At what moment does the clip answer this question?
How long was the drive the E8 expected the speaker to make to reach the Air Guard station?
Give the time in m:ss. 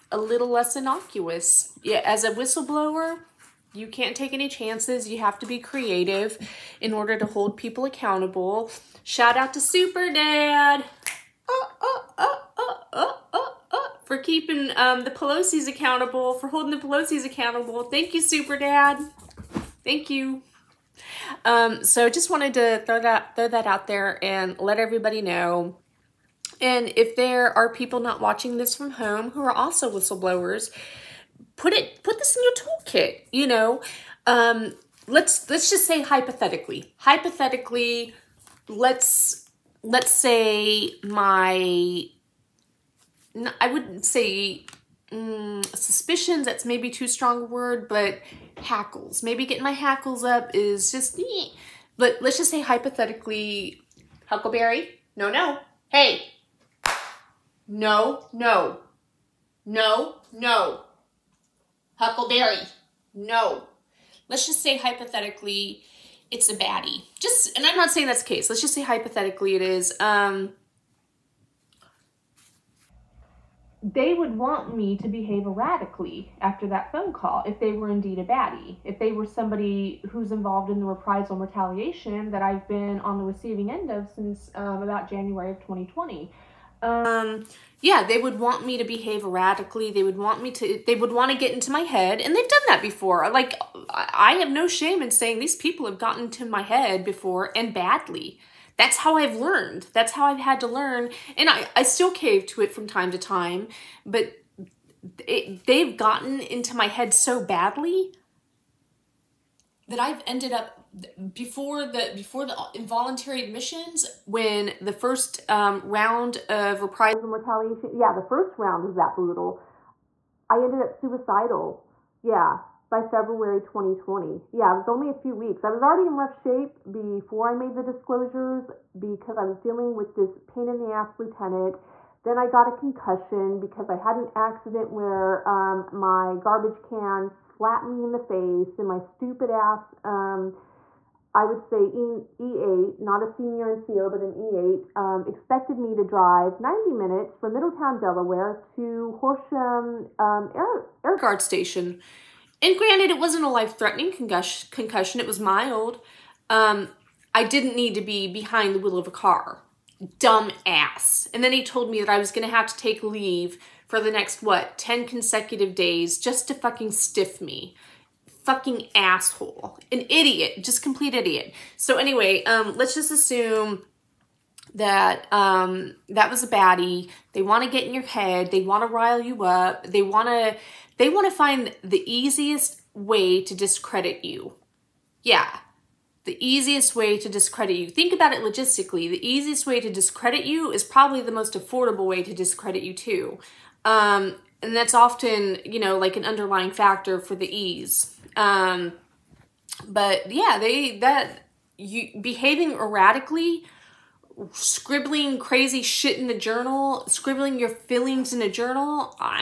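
2:26.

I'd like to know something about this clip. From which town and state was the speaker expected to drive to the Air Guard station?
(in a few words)
Middletown, Delaware.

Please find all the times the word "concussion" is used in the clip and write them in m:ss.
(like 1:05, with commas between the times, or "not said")
2:12, 2:34.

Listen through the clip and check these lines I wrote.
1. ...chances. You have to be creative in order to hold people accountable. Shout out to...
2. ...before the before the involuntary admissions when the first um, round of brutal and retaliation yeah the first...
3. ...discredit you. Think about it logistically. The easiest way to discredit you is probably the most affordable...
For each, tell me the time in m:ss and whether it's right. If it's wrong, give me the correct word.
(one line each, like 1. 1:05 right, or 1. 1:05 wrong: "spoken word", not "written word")
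1. 0:04 right
2. 1:51 wrong: "reprisal", not "brutal"
3. 3:07 right.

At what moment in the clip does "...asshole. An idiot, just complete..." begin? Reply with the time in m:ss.
2:48.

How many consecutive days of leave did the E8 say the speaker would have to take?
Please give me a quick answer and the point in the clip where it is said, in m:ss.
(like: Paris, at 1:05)
10 days, at 2:44.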